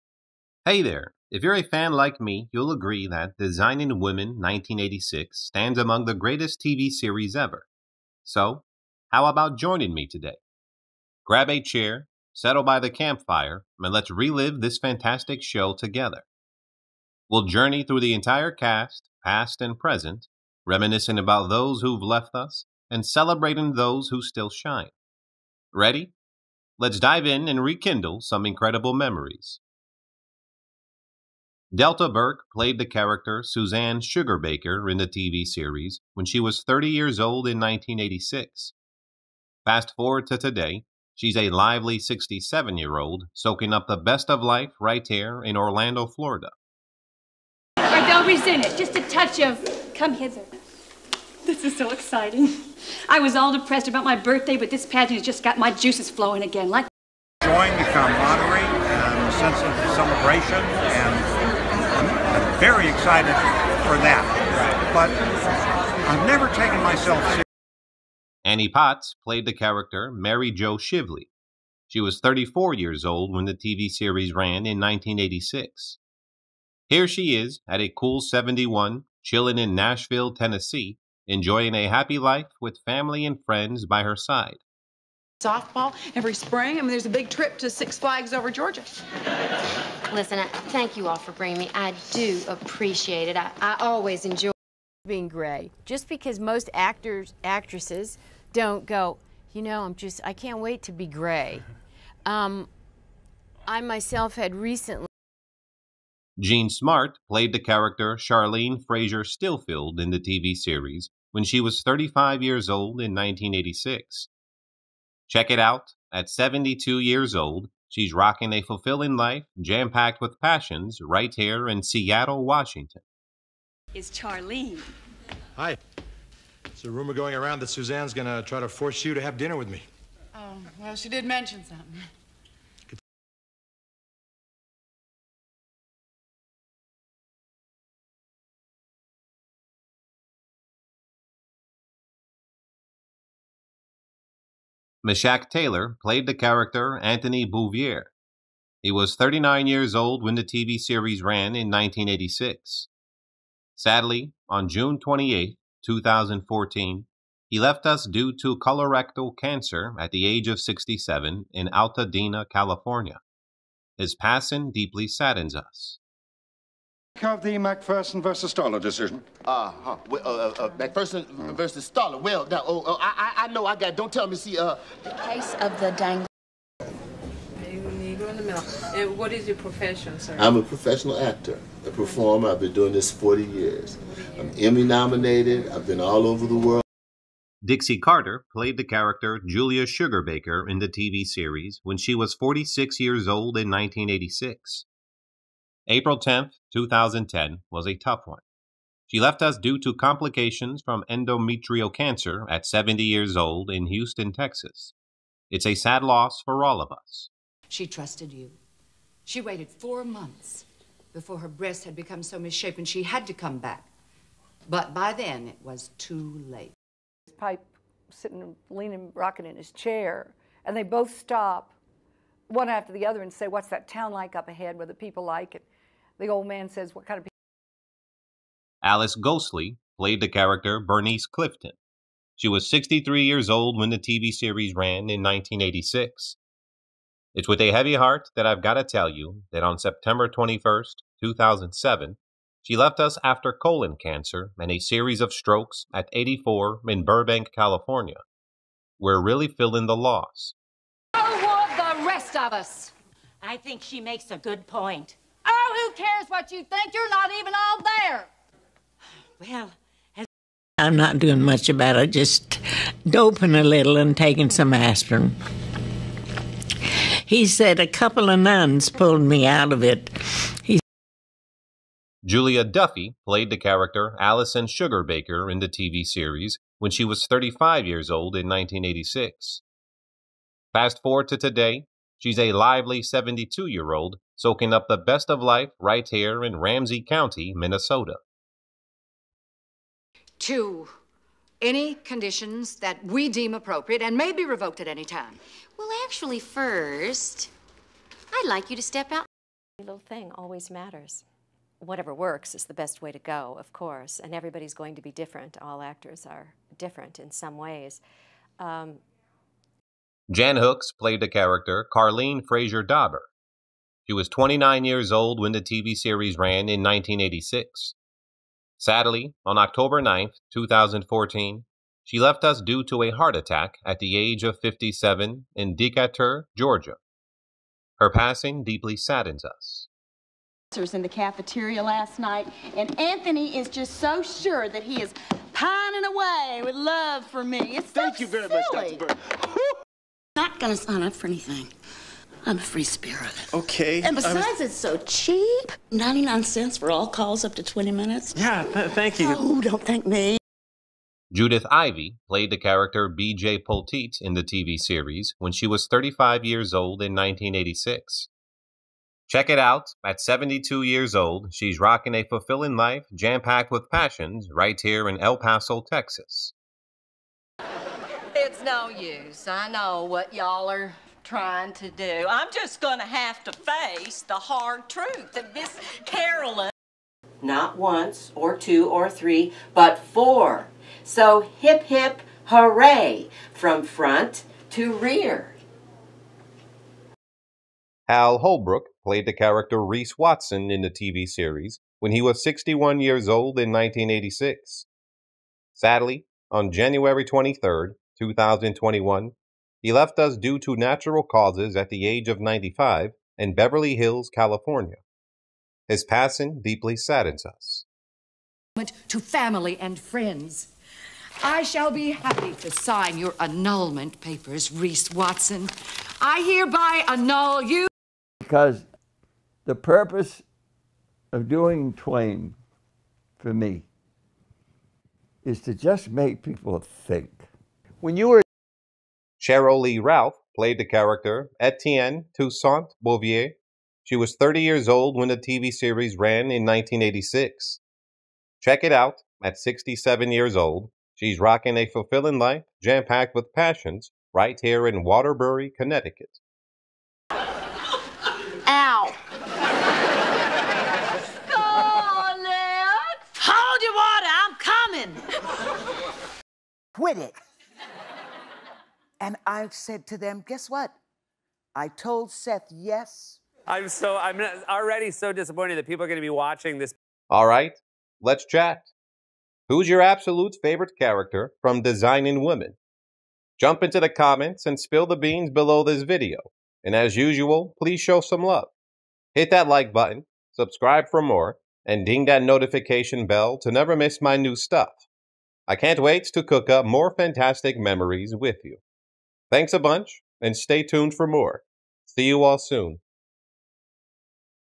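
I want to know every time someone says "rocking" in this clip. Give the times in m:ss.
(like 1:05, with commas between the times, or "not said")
1:58, 3:39, 6:01, 7:21.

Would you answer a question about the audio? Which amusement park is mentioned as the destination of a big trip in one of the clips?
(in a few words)
Six Flags over Georgia.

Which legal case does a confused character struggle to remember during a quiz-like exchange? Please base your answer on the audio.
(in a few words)
Macpherson versus Stoller.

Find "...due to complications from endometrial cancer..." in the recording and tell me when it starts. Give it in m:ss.
3:19.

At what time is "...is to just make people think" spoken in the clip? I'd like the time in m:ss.
7:05.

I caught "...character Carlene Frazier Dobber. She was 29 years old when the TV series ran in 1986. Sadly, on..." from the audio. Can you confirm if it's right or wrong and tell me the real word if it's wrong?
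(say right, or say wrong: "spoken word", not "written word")
right.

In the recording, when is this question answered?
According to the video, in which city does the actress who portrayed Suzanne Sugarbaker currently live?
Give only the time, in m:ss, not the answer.
0:45.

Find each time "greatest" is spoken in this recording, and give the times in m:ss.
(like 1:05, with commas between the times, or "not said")
0:06.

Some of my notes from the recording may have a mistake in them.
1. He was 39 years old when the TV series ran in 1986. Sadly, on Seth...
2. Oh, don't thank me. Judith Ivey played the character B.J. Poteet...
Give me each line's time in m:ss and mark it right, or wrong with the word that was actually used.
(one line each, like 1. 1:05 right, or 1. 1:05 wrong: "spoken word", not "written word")
1. 2:28 wrong: "June", not "Seth"
2. 5:49 right.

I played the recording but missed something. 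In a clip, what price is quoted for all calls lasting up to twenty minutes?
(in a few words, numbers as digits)
99 cents.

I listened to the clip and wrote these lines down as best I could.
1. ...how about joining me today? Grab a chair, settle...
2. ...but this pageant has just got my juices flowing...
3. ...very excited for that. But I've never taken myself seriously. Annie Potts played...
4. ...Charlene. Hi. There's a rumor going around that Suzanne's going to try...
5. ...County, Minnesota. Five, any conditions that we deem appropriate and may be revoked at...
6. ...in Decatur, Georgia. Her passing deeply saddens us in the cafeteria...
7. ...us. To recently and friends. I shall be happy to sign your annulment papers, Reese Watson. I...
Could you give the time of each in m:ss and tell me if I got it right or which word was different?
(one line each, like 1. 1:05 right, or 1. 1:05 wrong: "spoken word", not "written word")
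1. 0:09 right
2. 0:54 right
3. 1:02 right
4. 2:04 right
5. 4:47 wrong: "Two", not "Five"
6. 5:25 right
7. 6:47 wrong: "family", not "recently".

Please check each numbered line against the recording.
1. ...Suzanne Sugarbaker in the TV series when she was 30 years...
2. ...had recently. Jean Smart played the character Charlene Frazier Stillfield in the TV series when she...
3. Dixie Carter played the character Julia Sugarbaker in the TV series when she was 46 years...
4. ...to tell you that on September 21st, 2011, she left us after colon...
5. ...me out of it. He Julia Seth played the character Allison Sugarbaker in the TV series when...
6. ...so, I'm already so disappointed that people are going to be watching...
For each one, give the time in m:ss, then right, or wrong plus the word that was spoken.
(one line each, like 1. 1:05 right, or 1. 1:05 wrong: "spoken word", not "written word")
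1. 0:33 right
2. 1:44 right
3. 3:07 right
4. 3:58 wrong: "2007", not "2011"
5. 4:29 wrong: "Duffy", not "Seth"
6. 7:43 right.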